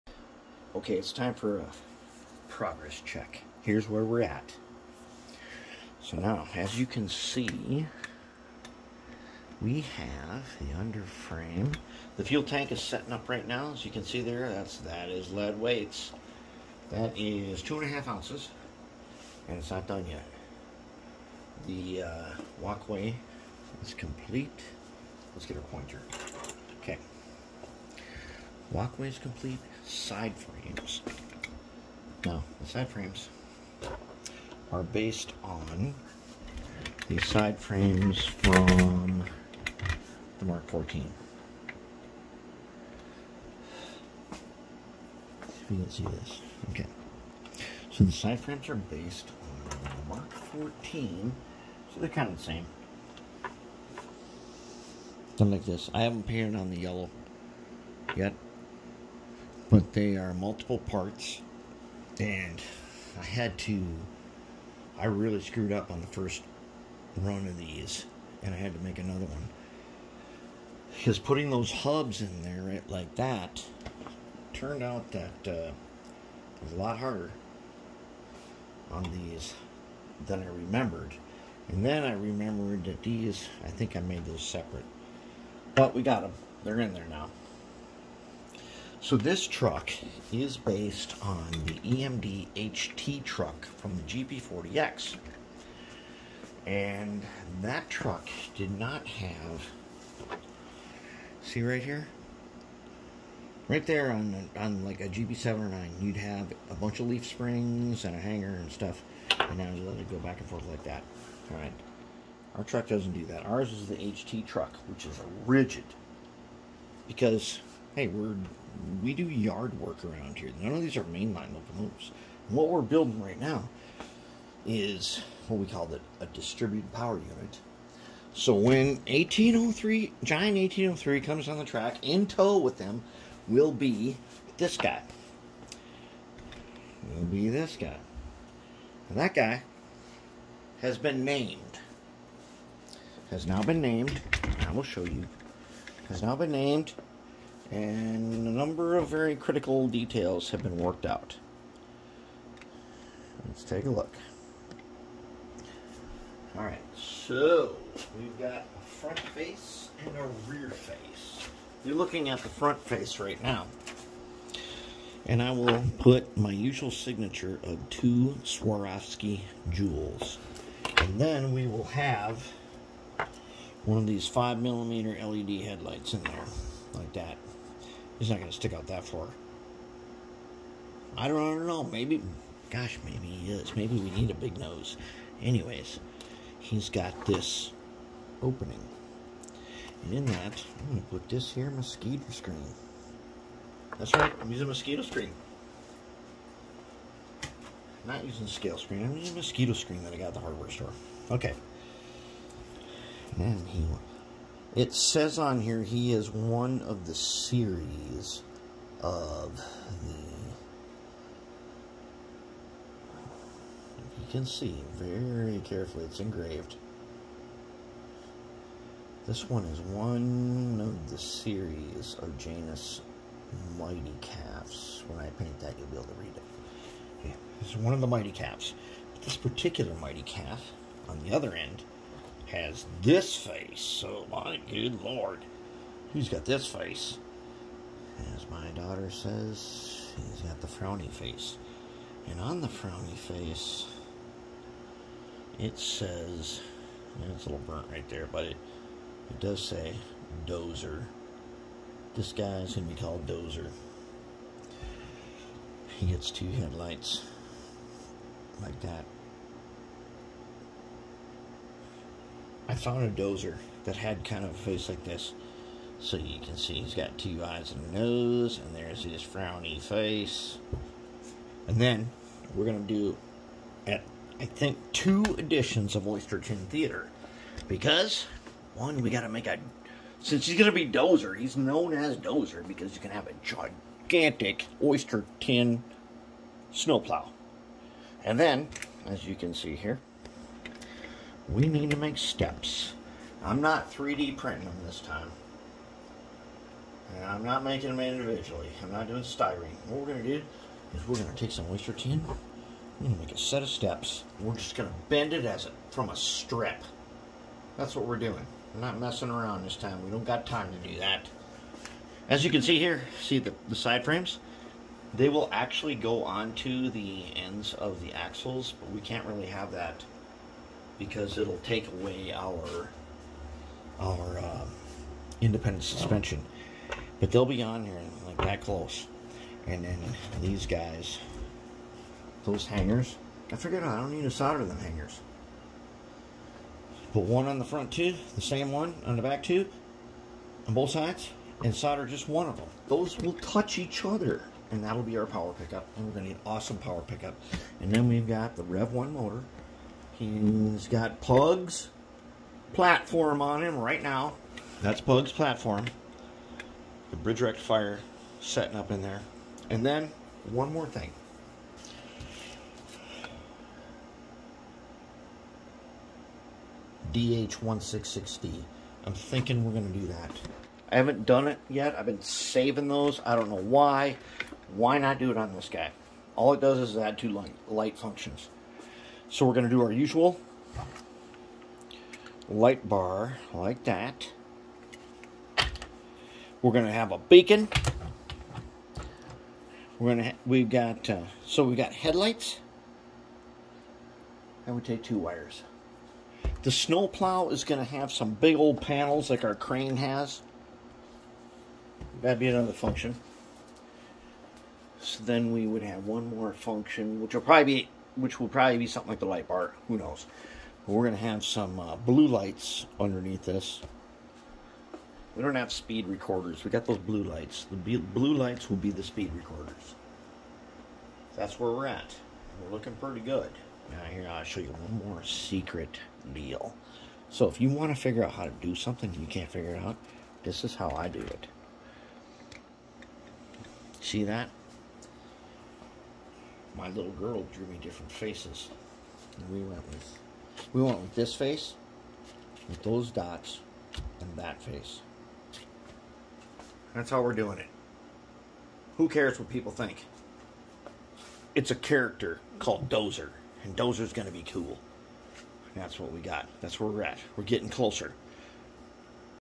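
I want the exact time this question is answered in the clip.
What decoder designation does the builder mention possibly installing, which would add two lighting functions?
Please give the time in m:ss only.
6:07.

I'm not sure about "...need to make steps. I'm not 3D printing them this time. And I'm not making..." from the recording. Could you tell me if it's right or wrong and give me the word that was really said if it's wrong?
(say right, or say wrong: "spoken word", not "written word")
right.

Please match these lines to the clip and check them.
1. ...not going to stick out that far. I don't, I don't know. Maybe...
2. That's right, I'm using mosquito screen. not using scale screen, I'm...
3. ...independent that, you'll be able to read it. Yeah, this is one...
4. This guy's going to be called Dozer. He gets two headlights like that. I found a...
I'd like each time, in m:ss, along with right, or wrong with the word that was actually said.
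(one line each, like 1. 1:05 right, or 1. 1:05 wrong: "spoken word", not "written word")
1. 2:58 right
2. 3:13 right
3. 3:45 wrong: "paint", not "independent"
4. 4:12 right.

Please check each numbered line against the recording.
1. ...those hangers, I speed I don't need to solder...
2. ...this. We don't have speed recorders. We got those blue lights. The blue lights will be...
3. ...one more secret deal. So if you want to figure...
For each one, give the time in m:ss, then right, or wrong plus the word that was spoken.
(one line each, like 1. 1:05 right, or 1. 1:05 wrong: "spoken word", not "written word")
1. 5:32 wrong: "figured", not "speed"
2. 6:53 right
3. 7:04 right.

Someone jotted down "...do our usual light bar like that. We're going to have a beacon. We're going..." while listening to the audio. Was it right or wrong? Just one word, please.
right.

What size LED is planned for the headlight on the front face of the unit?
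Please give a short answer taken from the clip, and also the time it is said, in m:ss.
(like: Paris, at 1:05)
5 millimeter, at 2:54.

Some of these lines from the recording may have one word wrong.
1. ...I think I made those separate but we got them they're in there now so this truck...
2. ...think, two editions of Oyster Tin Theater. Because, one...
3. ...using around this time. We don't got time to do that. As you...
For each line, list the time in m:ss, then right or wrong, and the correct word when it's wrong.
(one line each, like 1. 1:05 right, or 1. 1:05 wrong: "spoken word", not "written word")
1. 1:23 right
2. 4:34 right
3. 5:08 wrong: "messing", not "using".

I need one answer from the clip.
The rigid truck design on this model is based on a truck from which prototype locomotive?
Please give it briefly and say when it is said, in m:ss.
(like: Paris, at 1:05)
GP40X, at 1:34.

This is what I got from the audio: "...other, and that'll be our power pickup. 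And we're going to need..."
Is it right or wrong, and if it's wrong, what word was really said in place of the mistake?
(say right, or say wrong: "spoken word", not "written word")
right.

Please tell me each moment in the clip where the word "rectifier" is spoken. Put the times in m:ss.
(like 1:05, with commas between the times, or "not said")
5:57.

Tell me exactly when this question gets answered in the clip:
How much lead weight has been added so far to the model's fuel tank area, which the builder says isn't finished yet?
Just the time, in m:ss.
0:17.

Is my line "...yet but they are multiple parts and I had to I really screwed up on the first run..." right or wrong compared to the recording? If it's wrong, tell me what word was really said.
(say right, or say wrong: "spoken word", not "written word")
right.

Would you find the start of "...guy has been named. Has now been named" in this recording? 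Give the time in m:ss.
2:19.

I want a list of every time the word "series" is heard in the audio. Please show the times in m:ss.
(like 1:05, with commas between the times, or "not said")
3:27, 3:41.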